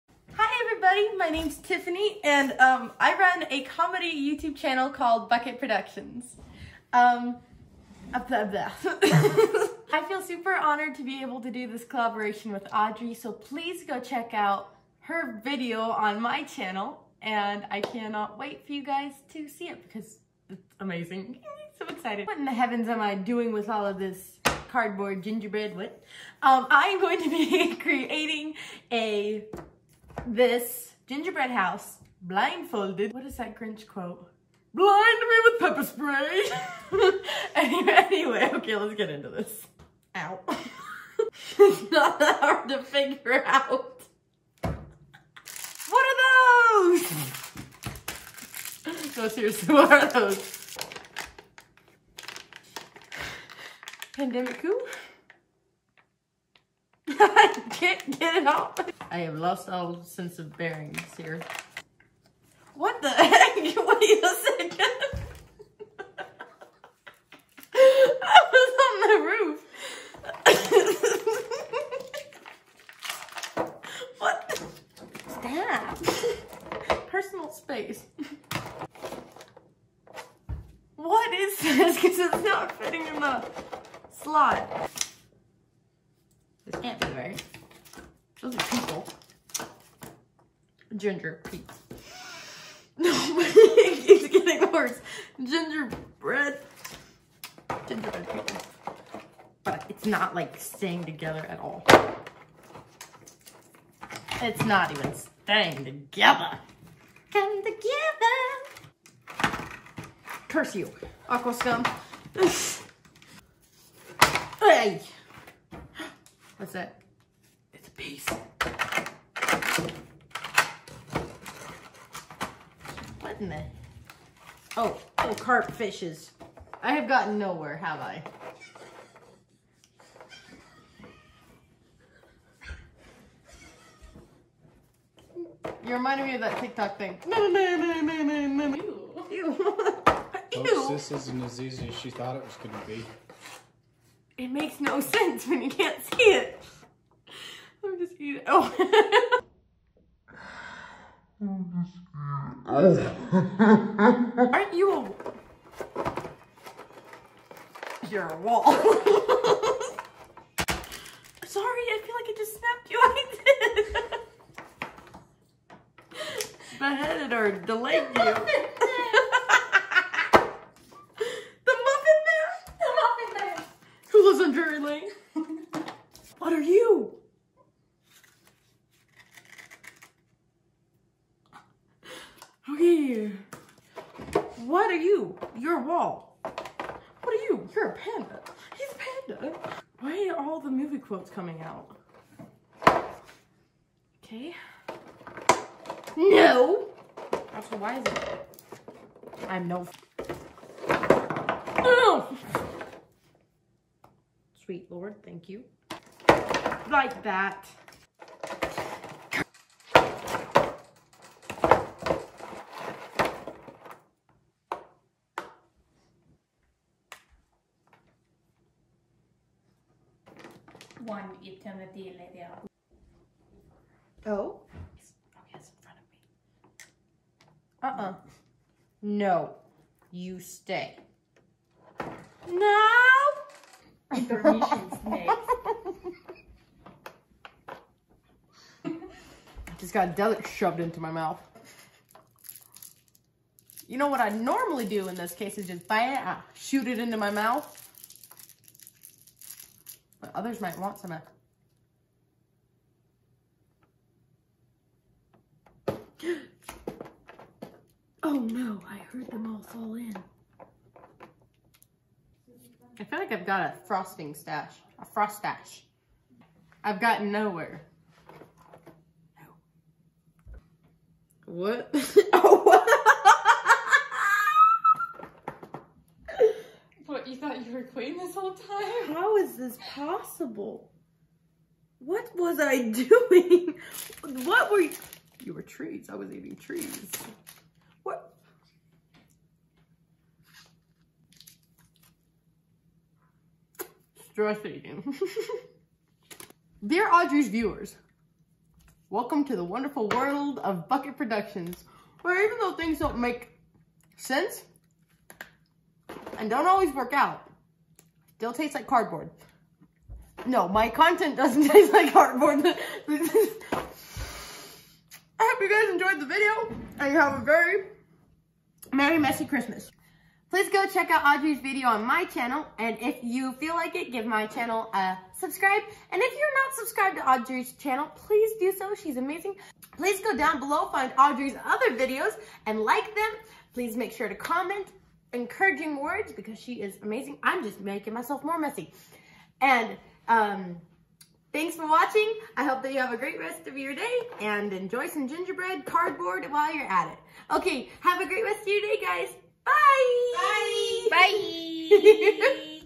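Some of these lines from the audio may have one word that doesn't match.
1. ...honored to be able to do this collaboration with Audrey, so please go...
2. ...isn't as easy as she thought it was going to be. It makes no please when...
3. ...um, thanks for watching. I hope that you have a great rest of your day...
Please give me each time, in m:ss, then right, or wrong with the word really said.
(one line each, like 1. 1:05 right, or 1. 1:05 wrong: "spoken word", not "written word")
1. 0:10 right
2. 2:21 wrong: "sense", not "please"
3. 5:40 right.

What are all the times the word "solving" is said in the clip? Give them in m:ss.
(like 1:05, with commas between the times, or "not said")
not said.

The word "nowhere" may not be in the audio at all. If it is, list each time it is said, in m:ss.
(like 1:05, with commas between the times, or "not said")
2:07, 4:27.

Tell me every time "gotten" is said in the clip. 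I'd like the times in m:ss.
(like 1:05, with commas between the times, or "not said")
2:07, 4:27.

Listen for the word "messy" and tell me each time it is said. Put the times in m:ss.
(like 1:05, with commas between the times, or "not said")
5:19, 5:38.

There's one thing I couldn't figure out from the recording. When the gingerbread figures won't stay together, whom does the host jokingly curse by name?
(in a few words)
Aqua Scum.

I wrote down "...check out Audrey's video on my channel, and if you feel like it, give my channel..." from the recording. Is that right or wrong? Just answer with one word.
right.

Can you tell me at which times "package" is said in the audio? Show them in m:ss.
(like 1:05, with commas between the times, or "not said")
not said.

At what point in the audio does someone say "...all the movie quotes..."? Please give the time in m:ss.
3:10.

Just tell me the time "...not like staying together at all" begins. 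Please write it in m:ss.
1:40.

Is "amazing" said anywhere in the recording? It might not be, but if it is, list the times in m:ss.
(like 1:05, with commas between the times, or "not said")
0:20, 5:29, 5:37.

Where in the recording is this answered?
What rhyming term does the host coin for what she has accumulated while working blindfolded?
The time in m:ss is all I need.
4:25.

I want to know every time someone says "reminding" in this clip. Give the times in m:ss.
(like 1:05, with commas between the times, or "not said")
2:15.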